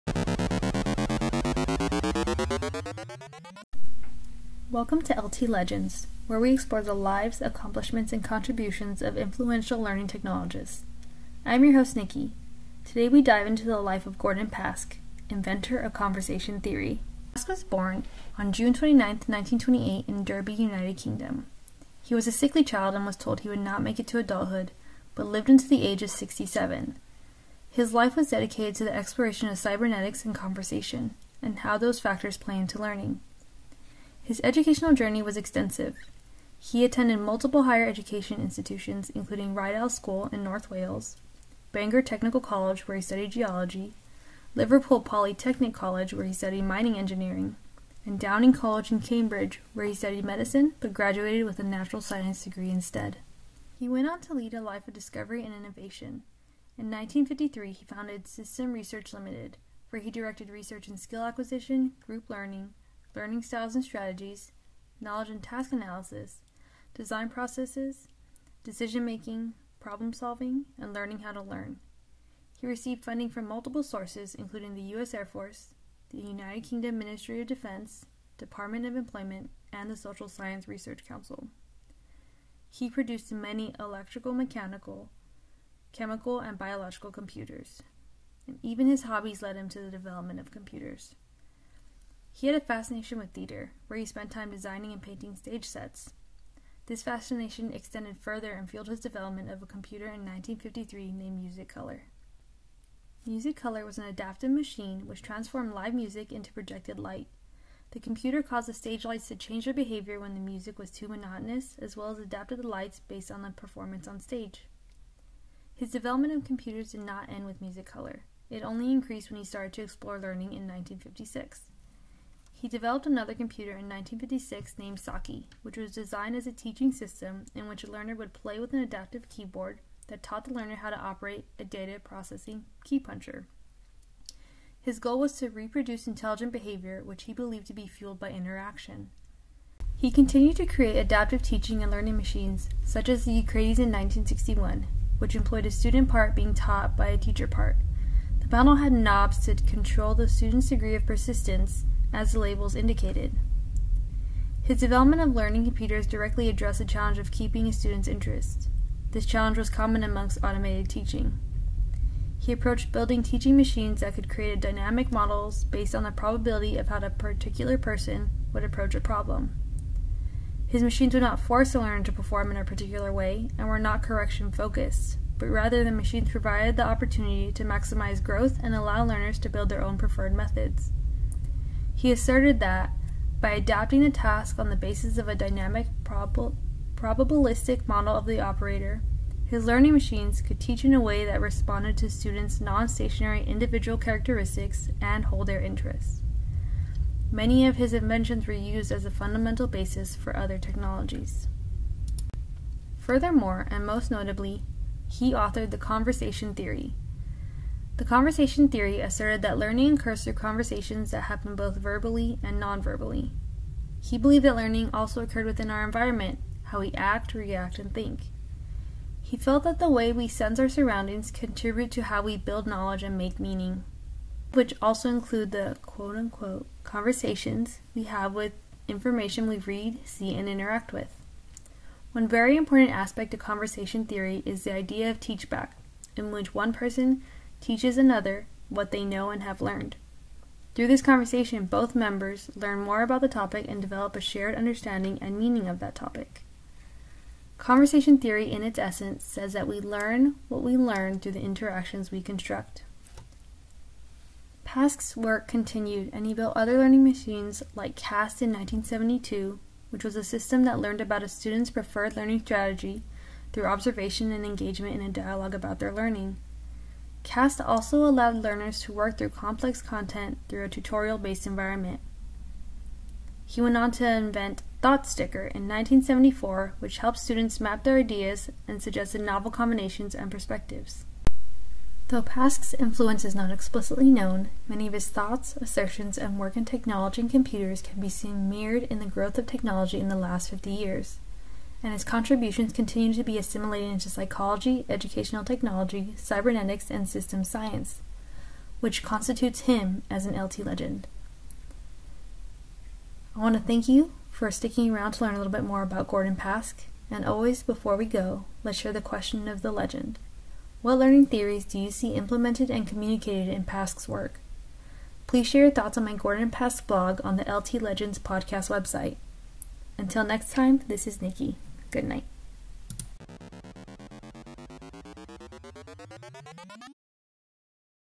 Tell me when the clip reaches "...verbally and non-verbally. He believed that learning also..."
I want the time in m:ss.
3:31.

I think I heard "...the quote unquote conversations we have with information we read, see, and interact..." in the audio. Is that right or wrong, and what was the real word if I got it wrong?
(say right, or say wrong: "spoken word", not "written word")
right.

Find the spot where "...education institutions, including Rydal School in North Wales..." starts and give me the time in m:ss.
0:37.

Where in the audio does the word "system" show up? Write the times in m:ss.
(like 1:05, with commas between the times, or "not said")
0:58, 2:06, 4:20, 4:57.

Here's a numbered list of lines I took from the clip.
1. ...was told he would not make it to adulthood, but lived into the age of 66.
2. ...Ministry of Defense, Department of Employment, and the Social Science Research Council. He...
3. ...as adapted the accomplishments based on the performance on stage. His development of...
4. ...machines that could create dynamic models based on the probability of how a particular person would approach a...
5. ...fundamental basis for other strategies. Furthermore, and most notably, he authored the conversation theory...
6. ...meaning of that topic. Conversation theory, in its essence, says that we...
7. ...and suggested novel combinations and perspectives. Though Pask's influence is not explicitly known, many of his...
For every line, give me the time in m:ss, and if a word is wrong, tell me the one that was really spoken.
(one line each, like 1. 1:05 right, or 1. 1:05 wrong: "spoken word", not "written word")
1. 0:23 wrong: "67", not "66"
2. 1:16 right
3. 1:52 wrong: "lights", not "accomplishments"
4. 2:43 right
5. 3:19 wrong: "technologies", not "strategies"
6. 4:05 right
7. 4:38 right.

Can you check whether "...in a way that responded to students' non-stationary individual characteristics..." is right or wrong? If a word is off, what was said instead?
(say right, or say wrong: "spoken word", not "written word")
right.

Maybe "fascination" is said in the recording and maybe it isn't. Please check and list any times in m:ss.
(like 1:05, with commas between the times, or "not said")
1:32, 1:37.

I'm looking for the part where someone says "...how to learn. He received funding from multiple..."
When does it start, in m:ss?
1:11.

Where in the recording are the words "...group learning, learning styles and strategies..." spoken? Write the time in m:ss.
1:02.